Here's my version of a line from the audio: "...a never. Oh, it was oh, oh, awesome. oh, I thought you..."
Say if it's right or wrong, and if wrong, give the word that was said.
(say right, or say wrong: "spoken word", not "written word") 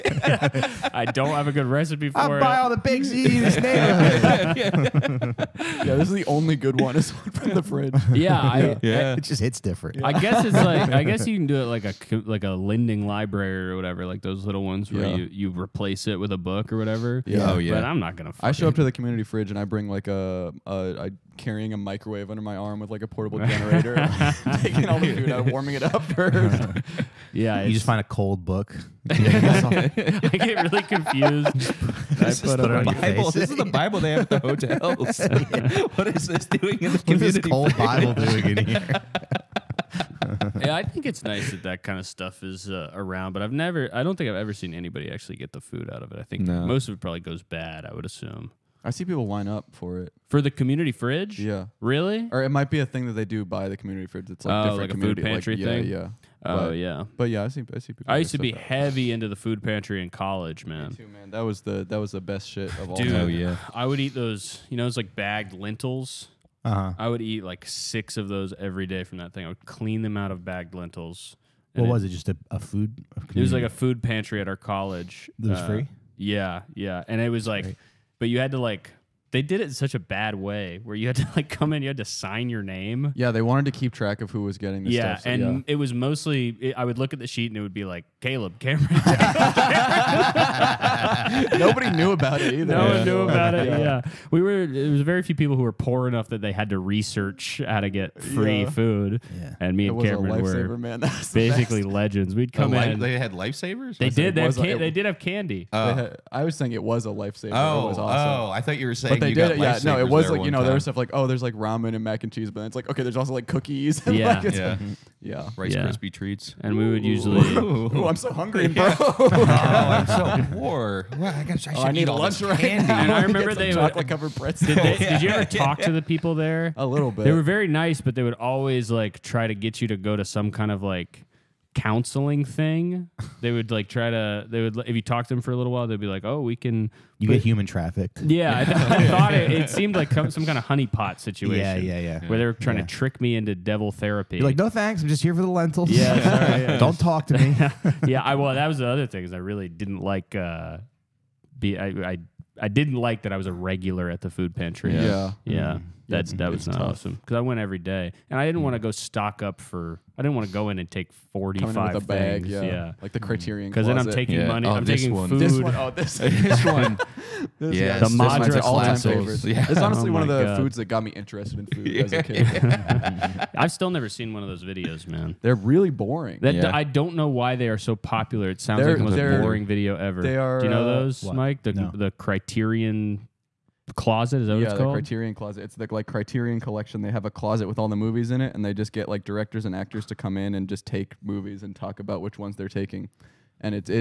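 wrong: "lifesaver", not "never".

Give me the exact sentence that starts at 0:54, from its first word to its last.
It's like Oh, different like a food community, pantry yeah, thing?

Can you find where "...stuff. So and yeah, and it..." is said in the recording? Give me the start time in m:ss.
1:25.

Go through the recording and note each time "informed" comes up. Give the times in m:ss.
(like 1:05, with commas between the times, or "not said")
not said.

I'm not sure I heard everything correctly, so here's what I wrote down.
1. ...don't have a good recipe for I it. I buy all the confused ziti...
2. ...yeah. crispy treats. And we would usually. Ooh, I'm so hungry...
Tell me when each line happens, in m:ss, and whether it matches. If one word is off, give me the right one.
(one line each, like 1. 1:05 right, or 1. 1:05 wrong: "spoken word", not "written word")
1. 0:01 wrong: "baked", not "confused"
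2. 1:55 right.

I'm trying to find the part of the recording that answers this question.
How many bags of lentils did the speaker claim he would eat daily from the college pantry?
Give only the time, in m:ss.
1:07.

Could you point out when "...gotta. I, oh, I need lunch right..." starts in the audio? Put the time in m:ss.
2:01.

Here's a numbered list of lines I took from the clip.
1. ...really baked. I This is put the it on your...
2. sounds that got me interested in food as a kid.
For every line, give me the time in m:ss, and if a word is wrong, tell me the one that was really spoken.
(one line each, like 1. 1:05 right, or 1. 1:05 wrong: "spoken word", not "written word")
1. 0:30 wrong: "confused", not "baked"
2. 2:50 wrong: "foods", not "sounds".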